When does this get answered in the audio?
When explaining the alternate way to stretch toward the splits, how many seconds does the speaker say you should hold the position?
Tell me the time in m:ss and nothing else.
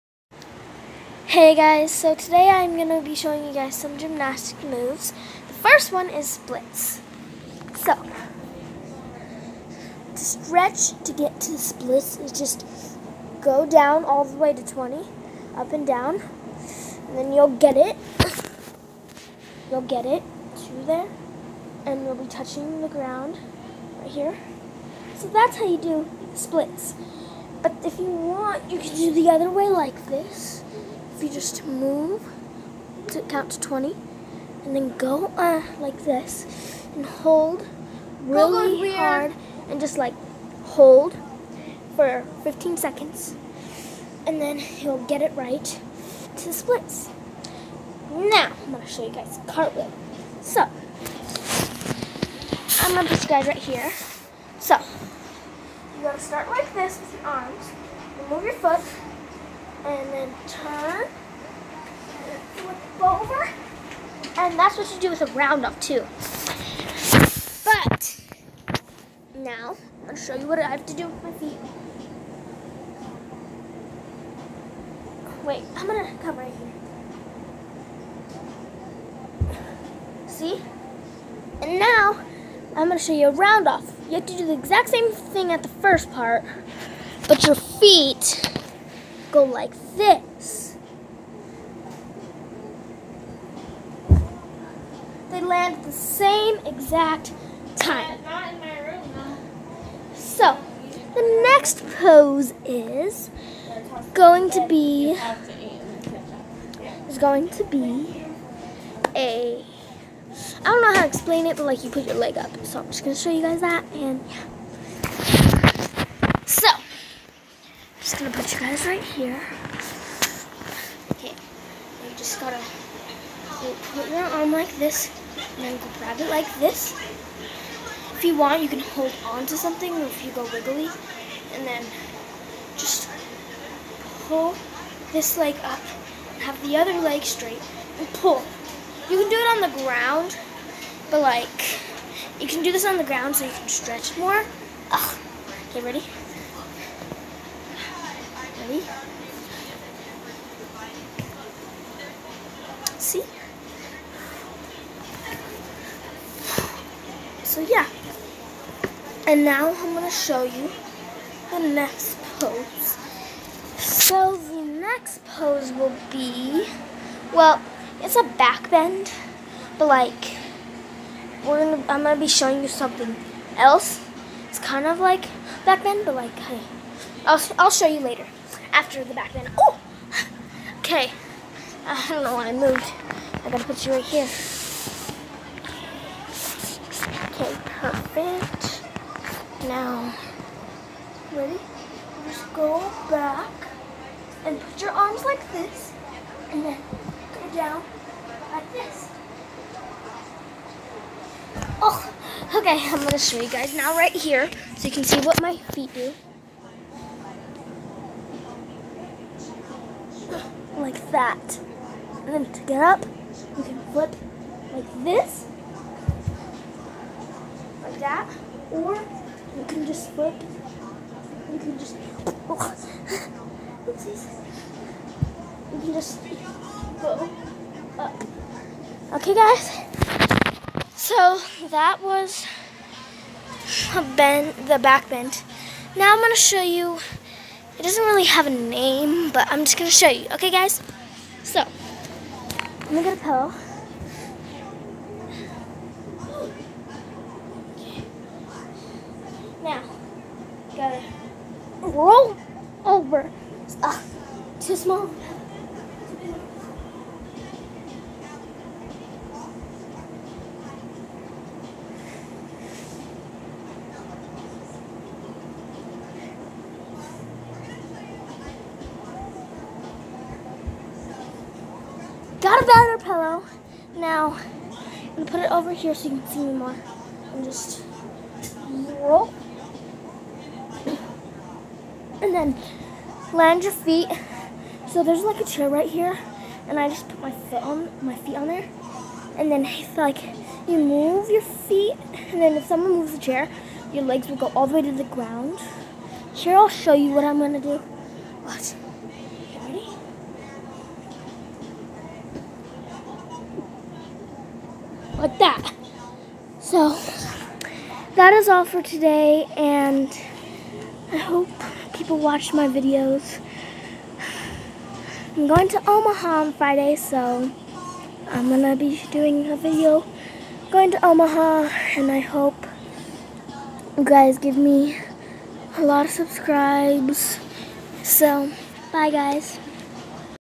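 0:42.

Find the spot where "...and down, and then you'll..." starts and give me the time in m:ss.
0:15.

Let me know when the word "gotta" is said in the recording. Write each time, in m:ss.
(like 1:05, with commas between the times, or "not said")
2:02, 3:03, 4:10.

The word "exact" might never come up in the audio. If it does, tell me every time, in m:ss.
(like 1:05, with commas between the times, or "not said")
1:24, 1:36.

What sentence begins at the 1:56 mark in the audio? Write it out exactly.
So just gonna put you guys right here.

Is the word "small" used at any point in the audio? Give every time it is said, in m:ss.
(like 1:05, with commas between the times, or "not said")
4:14.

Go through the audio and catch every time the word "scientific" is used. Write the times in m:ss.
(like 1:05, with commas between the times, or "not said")
not said.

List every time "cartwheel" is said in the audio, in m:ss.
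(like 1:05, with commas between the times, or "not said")
0:49.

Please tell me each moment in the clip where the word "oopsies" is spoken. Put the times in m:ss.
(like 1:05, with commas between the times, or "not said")
3:43.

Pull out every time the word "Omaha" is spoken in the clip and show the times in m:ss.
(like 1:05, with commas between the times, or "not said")
5:15, 5:21.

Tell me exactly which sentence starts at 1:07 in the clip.
But now I'm gonna show you what I have to do with my feet.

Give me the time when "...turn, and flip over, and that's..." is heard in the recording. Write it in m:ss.
1:00.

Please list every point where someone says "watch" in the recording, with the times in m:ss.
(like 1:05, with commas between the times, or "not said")
4:58, 5:12.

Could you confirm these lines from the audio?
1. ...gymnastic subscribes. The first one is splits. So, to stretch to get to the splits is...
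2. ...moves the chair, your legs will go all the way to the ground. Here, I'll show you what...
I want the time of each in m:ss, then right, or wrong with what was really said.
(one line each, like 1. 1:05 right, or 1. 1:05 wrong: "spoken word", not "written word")
1. 0:03 wrong: "moves", not "subscribes"
2. 4:52 right.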